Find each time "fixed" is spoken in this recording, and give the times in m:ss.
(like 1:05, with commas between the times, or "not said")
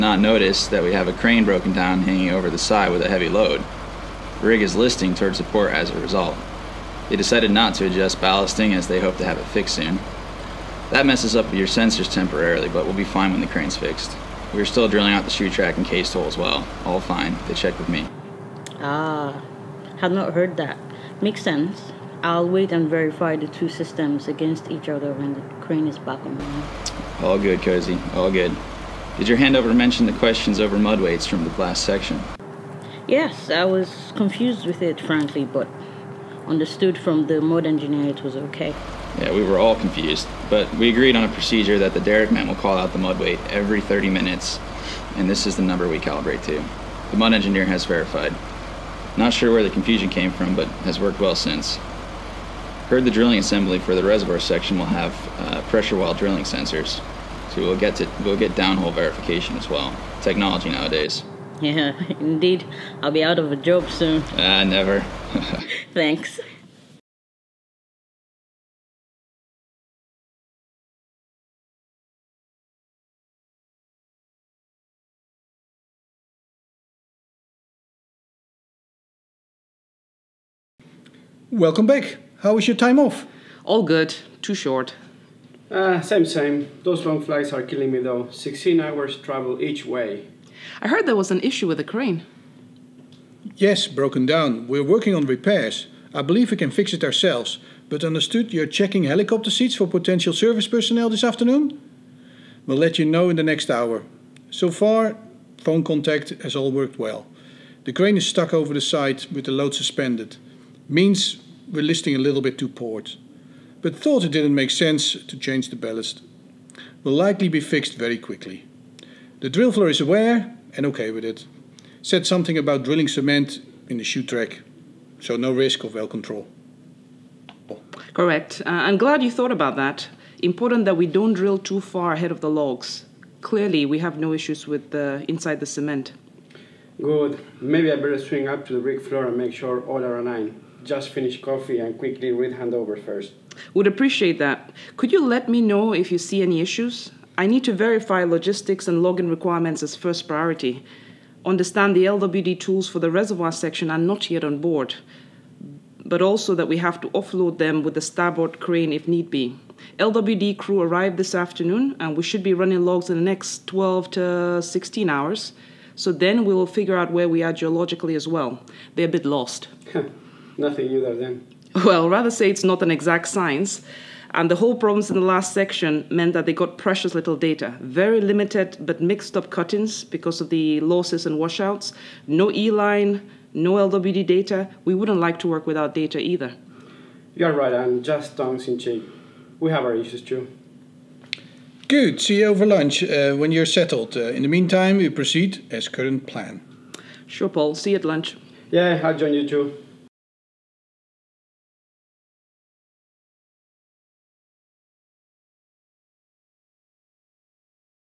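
0:09, 0:13, 1:57.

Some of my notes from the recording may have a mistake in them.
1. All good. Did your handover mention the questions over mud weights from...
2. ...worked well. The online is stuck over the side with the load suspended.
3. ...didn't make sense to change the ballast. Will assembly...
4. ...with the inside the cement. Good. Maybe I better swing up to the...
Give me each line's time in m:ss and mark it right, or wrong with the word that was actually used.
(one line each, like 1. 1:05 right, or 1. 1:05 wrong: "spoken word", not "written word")
1. 0:28 right
2. 1:46 wrong: "crane", not "online"
3. 1:54 wrong: "likely", not "assembly"
4. 2:14 right.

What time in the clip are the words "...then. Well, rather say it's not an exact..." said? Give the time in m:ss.
2:51.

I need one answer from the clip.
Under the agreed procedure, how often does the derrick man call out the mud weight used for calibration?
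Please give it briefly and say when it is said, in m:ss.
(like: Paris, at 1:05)
every 30 minutes, at 0:43.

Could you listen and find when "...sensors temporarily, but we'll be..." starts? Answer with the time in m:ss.
0:11.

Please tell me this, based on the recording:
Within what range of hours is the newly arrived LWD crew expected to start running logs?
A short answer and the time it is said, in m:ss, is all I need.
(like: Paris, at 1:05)
12 to 16 hours, at 2:43.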